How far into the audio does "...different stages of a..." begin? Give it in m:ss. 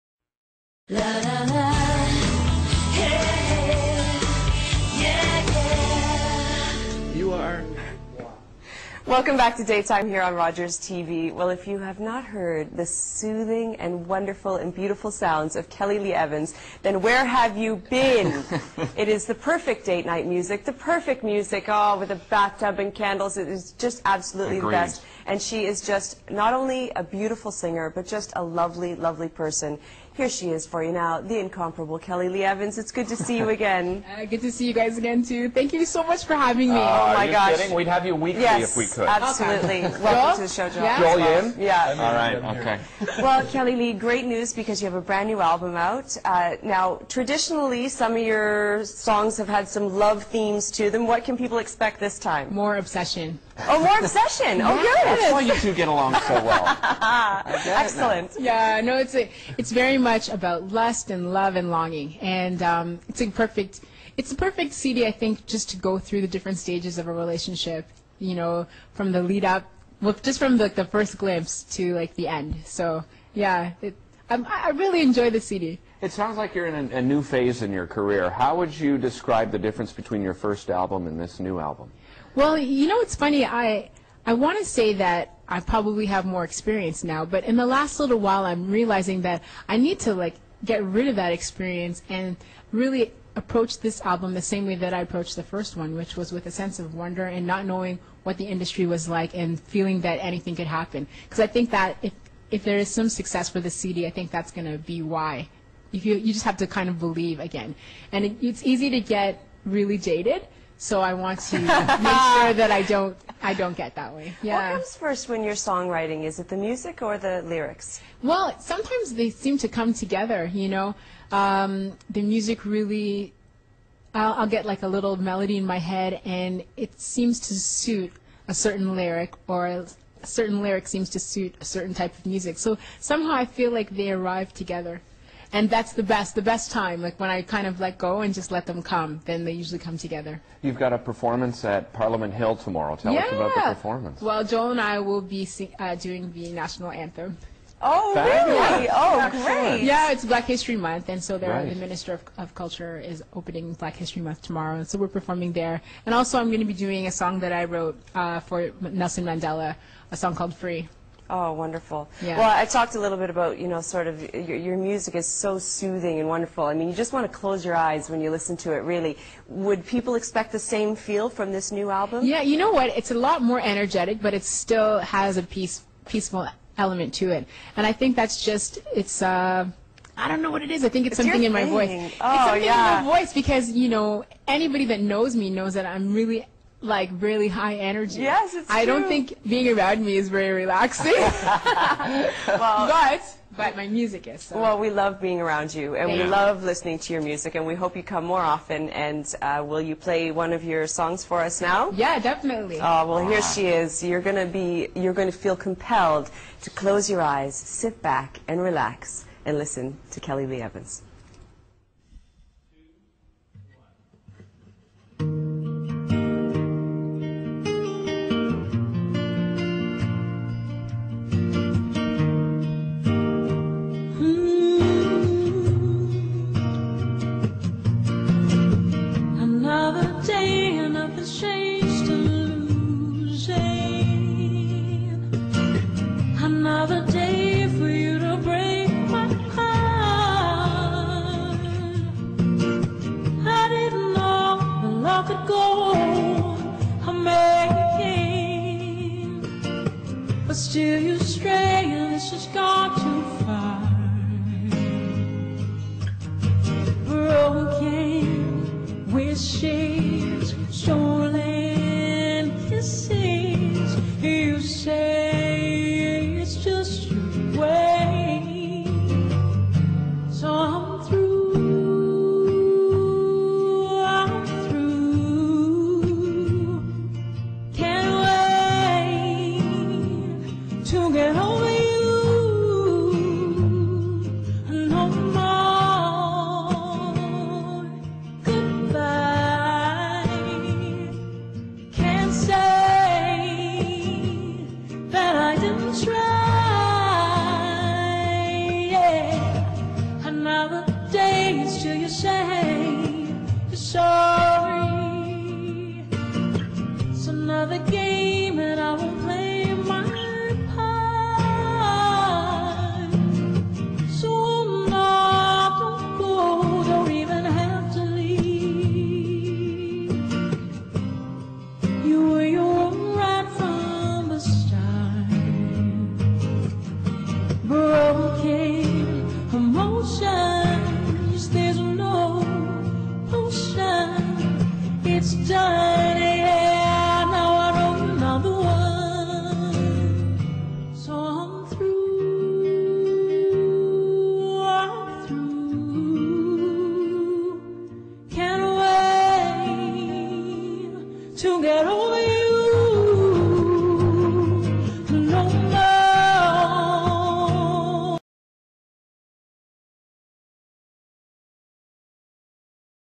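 1:06.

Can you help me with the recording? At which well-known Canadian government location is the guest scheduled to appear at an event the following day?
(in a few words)
Parliament Hill.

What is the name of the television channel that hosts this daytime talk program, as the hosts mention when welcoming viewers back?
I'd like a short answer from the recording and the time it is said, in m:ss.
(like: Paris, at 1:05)
Rogers TV, at 0:10.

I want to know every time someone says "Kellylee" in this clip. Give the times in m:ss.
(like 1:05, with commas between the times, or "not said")
0:15, 0:31, 0:43, 3:30.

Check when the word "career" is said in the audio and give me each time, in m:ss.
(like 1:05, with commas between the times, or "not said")
1:17.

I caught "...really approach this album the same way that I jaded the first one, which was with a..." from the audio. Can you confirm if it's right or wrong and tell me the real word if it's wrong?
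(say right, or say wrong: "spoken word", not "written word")
wrong: "approached", not "jaded".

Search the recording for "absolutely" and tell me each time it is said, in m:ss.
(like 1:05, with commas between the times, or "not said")
0:24, 0:39.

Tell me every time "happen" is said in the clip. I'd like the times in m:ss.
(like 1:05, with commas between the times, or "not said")
1:40.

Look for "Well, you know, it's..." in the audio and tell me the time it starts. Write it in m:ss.
1:22.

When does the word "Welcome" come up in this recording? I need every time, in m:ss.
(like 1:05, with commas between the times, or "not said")
0:09, 0:40.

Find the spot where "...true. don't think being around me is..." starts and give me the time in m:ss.
3:08.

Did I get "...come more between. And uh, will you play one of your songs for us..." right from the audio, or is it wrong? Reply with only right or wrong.
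wrong.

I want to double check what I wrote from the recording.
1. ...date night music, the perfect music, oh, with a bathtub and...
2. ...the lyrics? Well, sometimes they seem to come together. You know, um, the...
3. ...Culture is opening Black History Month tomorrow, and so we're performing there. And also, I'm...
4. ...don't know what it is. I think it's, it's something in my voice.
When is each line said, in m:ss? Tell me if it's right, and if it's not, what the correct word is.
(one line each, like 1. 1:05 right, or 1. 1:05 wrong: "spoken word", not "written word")
1. 0:19 right
2. 1:57 right
3. 2:32 right
4. 3:00 right.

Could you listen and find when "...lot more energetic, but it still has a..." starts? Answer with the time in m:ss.
2:53.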